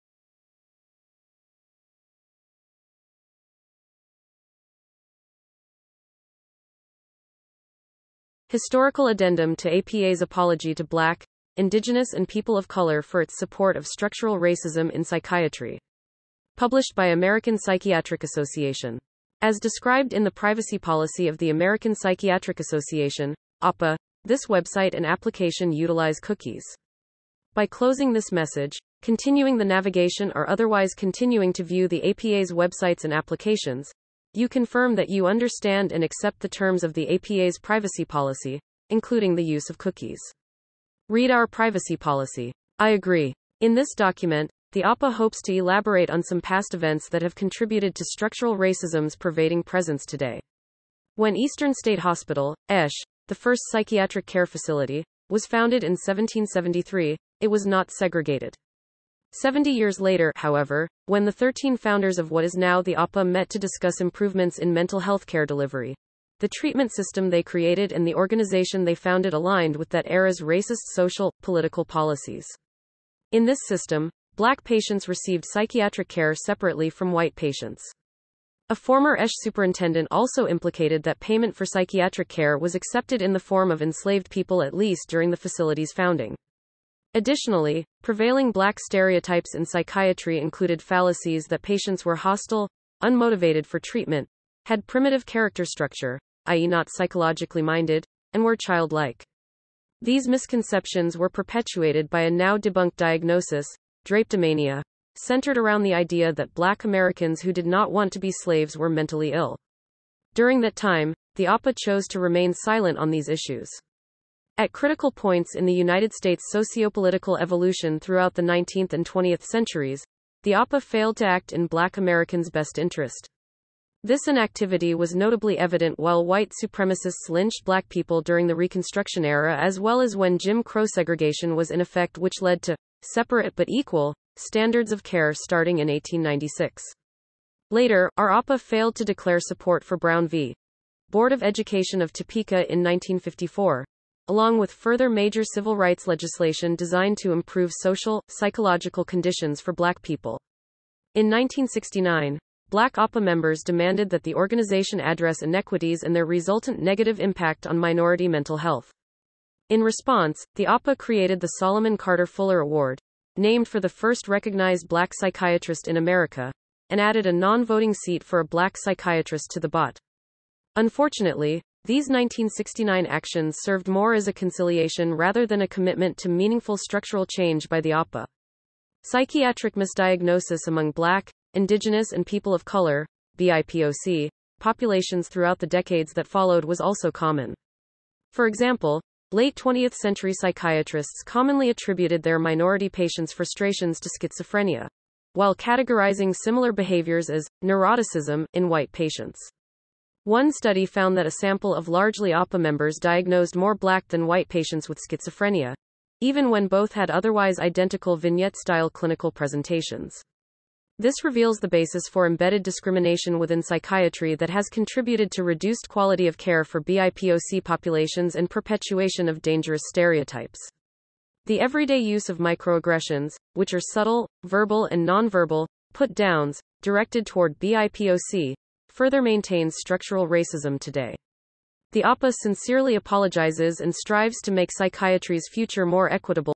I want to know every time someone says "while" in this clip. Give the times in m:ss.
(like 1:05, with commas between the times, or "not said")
2:05, 3:15.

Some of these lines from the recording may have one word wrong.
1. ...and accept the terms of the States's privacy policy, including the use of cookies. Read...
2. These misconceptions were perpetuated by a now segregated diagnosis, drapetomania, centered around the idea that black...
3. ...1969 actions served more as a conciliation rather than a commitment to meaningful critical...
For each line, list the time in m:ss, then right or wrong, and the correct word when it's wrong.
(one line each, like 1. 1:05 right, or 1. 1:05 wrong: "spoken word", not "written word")
1. 0:35 wrong: "APA", not "States"
2. 1:40 wrong: "debunked", not "segregated"
3. 2:52 wrong: "structural", not "critical".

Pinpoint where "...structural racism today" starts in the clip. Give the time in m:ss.
3:49.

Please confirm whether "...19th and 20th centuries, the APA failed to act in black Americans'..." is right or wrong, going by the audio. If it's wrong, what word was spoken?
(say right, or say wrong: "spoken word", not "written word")
right.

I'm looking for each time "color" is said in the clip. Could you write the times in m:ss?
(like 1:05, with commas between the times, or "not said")
0:12, 3:02.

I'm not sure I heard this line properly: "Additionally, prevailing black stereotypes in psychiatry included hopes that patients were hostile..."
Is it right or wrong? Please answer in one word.
wrong.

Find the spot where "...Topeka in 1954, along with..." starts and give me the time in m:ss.
2:22.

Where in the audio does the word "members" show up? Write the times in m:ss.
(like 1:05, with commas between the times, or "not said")
2:33, 3:22.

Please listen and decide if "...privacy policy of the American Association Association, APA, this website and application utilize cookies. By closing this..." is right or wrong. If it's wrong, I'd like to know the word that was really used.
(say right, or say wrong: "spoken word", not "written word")
wrong: "Psychiatric", not "Association".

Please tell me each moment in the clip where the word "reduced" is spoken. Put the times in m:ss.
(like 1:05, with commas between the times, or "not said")
3:35.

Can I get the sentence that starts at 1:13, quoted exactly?
In this system, black patients received psychiatric care separately from white patients.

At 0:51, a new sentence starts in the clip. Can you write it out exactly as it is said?
When Eastern State Hospital, ESH, the first psychiatric care facility, was founded in 1773, it was not segregated.